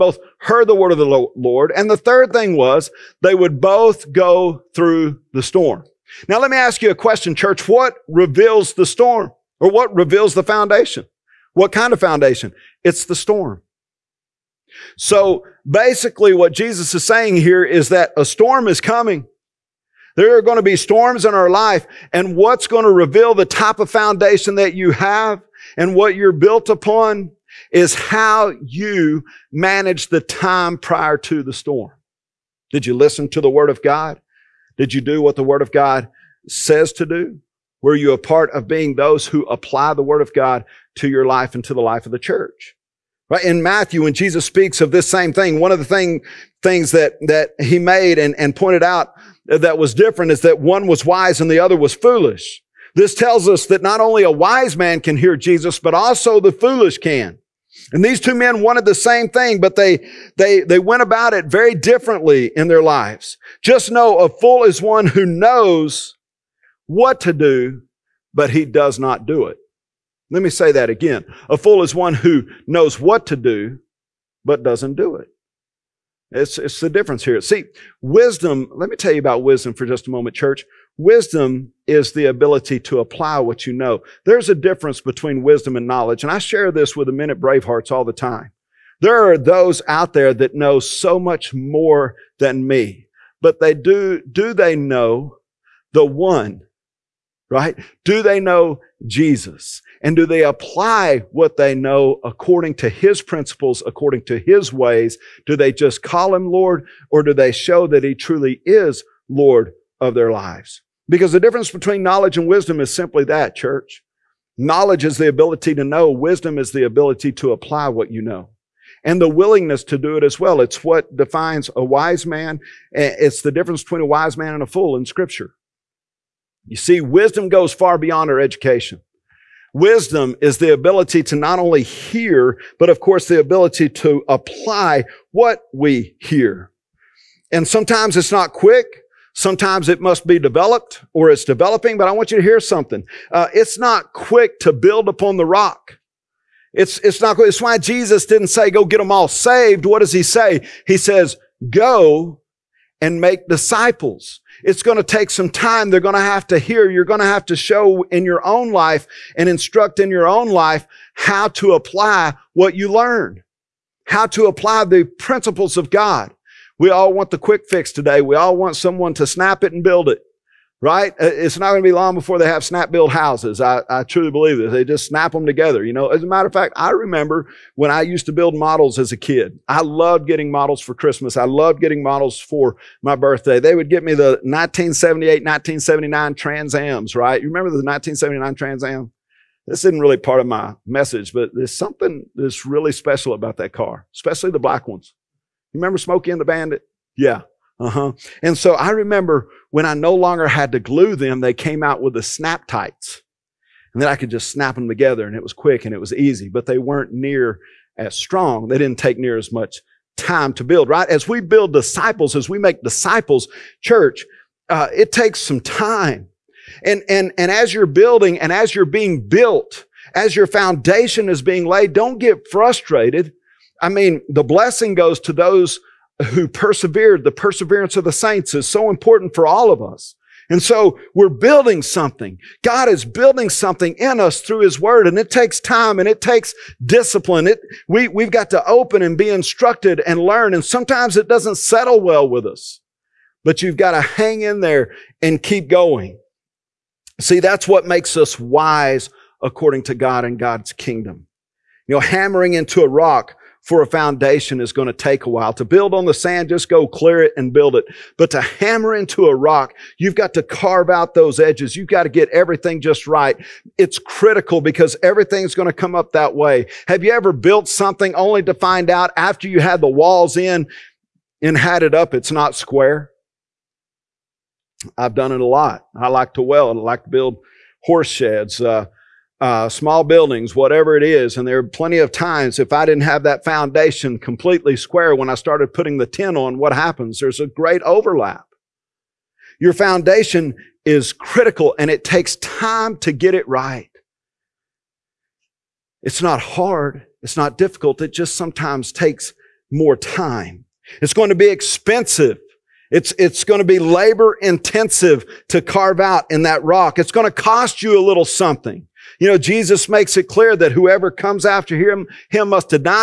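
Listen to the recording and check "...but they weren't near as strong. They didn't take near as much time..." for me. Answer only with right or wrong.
right.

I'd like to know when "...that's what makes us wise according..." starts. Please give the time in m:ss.
4:07.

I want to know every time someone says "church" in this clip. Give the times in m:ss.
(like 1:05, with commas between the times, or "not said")
0:07, 0:42, 1:20, 1:53, 3:33.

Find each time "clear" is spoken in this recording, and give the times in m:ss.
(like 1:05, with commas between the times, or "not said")
4:16, 5:10.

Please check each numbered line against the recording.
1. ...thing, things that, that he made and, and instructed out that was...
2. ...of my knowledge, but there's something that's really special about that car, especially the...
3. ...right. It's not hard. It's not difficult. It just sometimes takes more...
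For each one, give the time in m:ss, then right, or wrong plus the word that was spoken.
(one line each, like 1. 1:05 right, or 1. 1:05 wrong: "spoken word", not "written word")
1. 0:45 wrong: "pointed", not "instructed"
2. 3:10 wrong: "message", not "knowledge"
3. 4:53 right.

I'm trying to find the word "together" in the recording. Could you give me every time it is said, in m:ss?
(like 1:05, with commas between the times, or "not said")
2:55, 3:24.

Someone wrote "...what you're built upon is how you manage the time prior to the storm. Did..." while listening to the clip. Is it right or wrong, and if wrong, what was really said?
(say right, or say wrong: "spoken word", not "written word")
right.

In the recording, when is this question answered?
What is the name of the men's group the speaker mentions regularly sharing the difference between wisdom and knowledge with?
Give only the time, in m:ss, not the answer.
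1:27.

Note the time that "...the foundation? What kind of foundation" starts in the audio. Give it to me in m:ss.
0:10.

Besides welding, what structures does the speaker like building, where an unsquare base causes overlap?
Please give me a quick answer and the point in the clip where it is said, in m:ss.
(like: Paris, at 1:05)
horse sheds, at 4:37.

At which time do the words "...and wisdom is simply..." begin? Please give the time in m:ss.
1:52.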